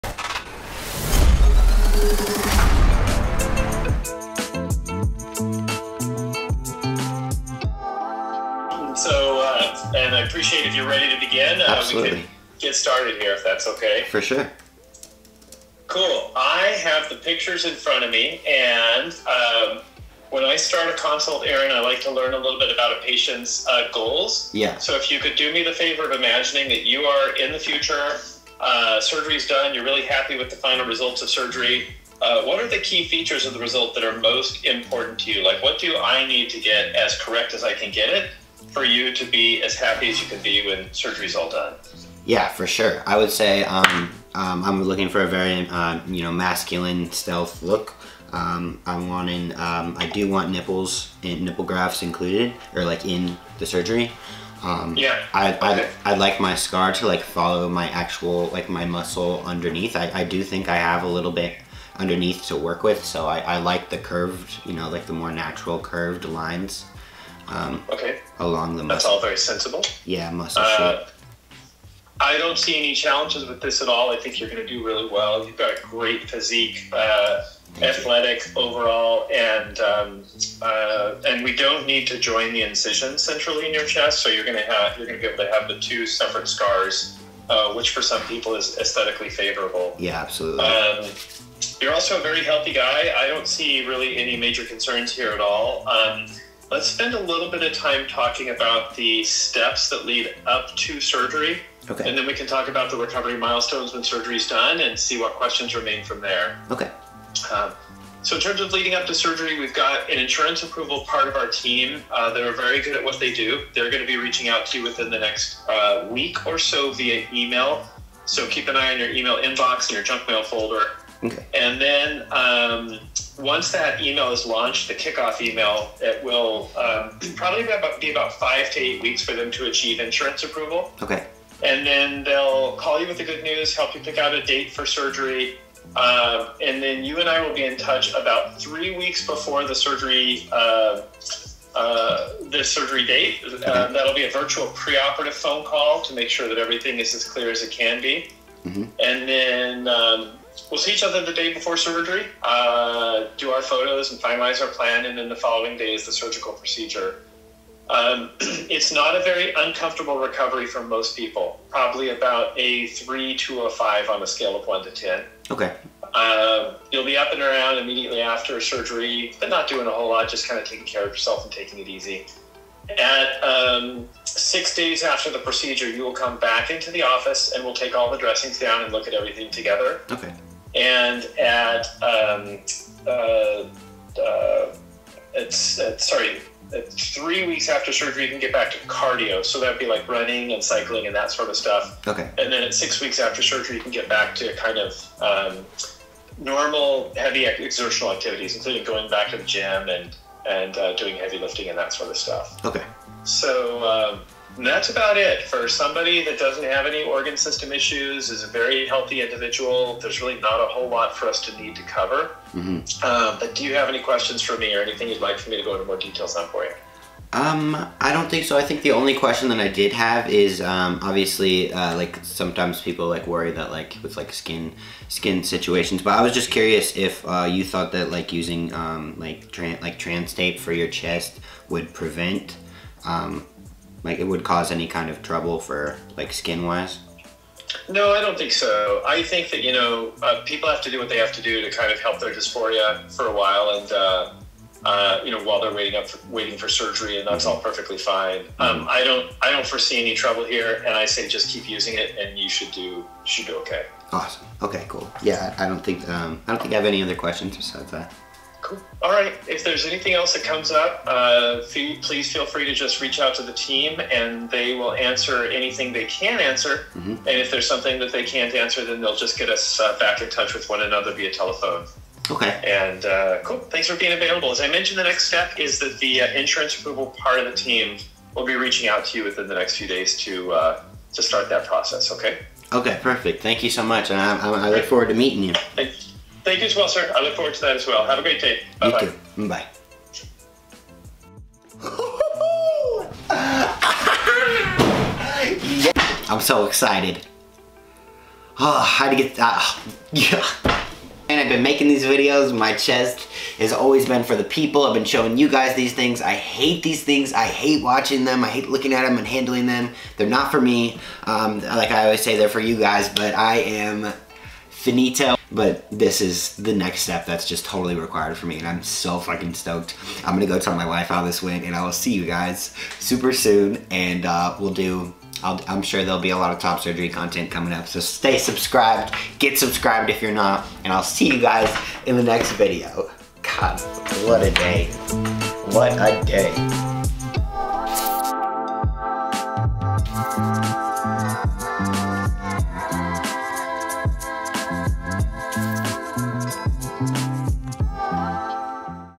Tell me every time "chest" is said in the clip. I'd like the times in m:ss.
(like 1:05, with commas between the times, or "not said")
1:23, 3:50, 5:02.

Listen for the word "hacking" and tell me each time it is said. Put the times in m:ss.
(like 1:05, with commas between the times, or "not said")
not said.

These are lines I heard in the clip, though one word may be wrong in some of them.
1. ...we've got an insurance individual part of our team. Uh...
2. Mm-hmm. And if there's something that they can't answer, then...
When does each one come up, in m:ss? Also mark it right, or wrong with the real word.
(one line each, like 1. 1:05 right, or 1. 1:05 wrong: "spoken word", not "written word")
1. 1:49 wrong: "approval", not "individual"
2. 4:26 right.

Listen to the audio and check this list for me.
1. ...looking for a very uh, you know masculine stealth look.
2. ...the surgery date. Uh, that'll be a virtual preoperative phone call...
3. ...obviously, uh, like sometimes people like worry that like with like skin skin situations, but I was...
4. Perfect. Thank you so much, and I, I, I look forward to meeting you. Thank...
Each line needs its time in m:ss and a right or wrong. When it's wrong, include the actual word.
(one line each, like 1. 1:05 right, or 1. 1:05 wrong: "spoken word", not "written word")
1. 0:44 right
2. 2:22 right
3. 3:41 right
4. 4:43 right.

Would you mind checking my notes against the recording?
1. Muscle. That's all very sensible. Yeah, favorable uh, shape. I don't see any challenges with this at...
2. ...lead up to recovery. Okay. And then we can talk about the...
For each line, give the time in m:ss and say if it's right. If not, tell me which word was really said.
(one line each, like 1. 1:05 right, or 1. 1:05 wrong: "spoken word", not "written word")
1. 1:08 wrong: "muscle", not "favorable"
2. 1:40 wrong: "surgery", not "recovery".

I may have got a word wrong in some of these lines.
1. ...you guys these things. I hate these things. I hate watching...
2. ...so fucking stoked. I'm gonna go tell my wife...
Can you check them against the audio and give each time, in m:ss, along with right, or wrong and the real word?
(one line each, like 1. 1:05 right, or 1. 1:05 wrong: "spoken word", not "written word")
1. 5:05 right
2. 5:18 right.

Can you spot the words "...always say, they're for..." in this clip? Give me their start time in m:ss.
5:12.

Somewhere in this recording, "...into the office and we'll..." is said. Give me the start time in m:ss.
2:56.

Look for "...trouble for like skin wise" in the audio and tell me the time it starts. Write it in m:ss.
3:55.